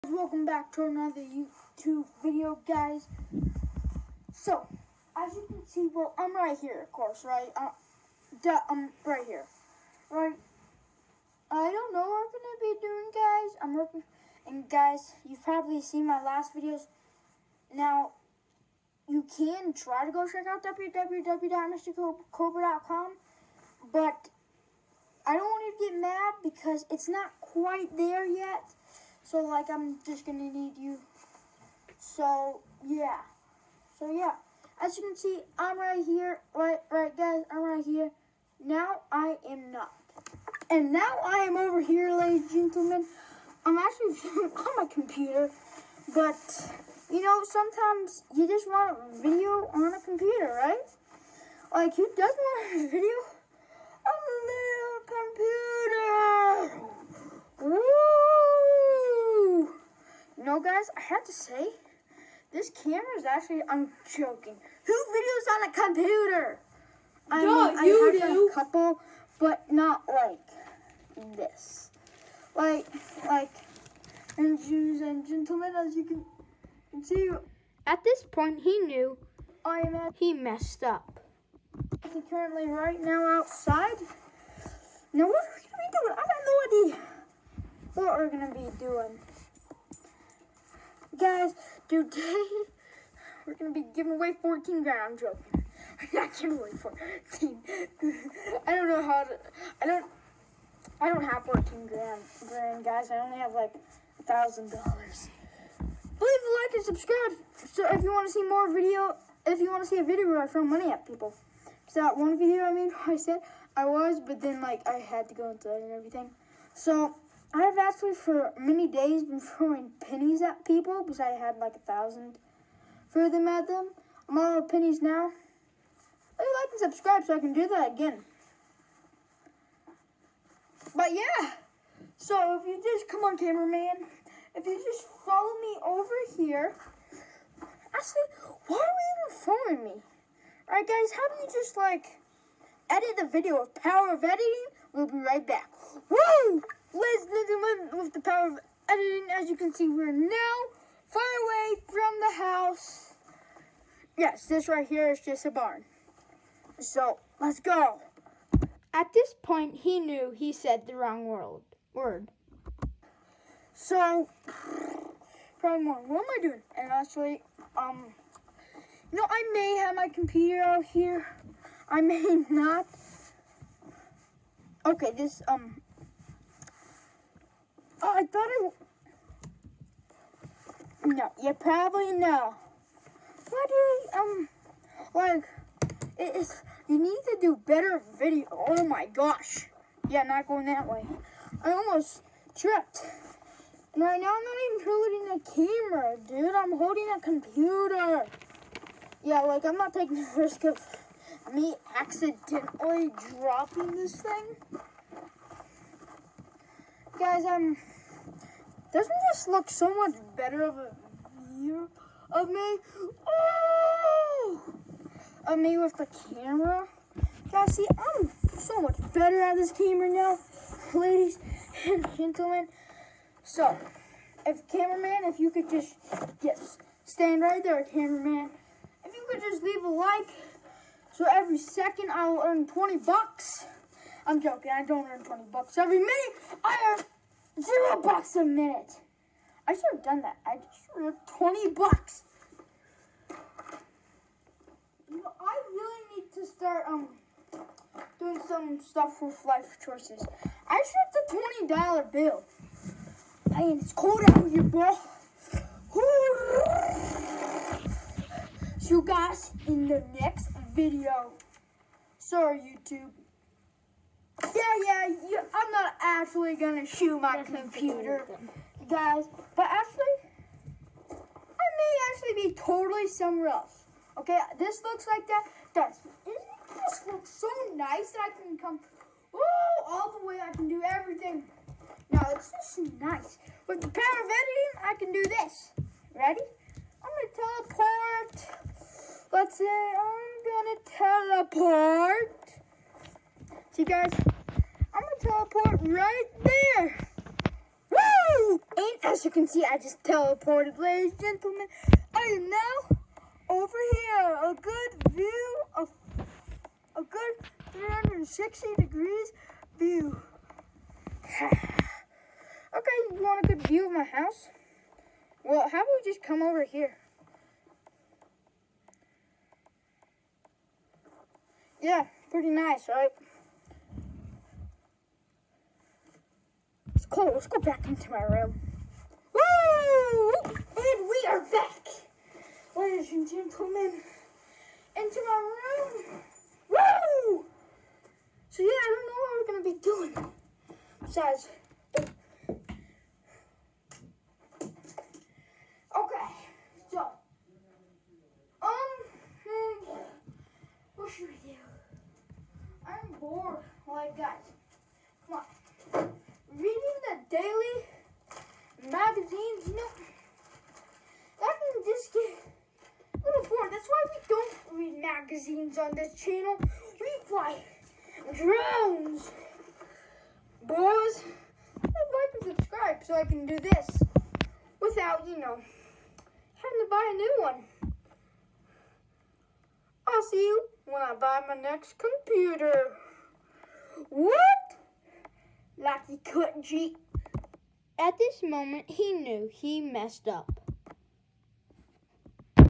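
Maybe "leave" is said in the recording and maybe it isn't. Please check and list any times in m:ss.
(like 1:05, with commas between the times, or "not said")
1:45, 3:49.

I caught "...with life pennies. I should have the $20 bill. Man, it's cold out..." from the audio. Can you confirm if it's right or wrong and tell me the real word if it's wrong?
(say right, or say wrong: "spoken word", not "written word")
wrong: "choices", not "pennies".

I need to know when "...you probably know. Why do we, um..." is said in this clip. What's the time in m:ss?
3:01.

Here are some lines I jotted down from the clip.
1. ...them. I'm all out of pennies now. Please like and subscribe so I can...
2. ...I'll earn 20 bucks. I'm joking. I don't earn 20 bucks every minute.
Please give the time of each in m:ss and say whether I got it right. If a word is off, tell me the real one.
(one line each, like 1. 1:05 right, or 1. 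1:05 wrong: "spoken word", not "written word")
1. 2:03 right
2. 3:52 right.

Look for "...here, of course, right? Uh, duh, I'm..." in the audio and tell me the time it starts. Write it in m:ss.
0:06.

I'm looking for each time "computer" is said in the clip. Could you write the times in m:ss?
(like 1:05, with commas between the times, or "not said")
0:44, 0:50, 0:56, 1:05, 2:50, 3:17, 4:27, 6:21.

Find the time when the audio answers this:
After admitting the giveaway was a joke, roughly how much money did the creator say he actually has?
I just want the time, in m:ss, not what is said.
1:44.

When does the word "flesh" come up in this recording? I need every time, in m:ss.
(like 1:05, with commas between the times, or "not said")
not said.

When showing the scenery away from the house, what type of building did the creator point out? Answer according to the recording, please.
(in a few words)
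barn.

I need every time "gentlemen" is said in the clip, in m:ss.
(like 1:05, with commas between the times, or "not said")
0:42, 1:15, 3:42, 5:01, 5:33.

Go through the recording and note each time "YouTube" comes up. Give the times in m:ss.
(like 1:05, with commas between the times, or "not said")
0:01, 4:22.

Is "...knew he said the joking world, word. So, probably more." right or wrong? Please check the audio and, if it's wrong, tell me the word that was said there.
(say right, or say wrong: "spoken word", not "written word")
wrong: "wrong", not "joking".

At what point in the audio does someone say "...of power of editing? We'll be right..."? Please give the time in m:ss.
2:23.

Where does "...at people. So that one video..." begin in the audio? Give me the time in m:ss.
1:50.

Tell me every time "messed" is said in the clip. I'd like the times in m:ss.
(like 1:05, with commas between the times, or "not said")
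1:20, 6:29.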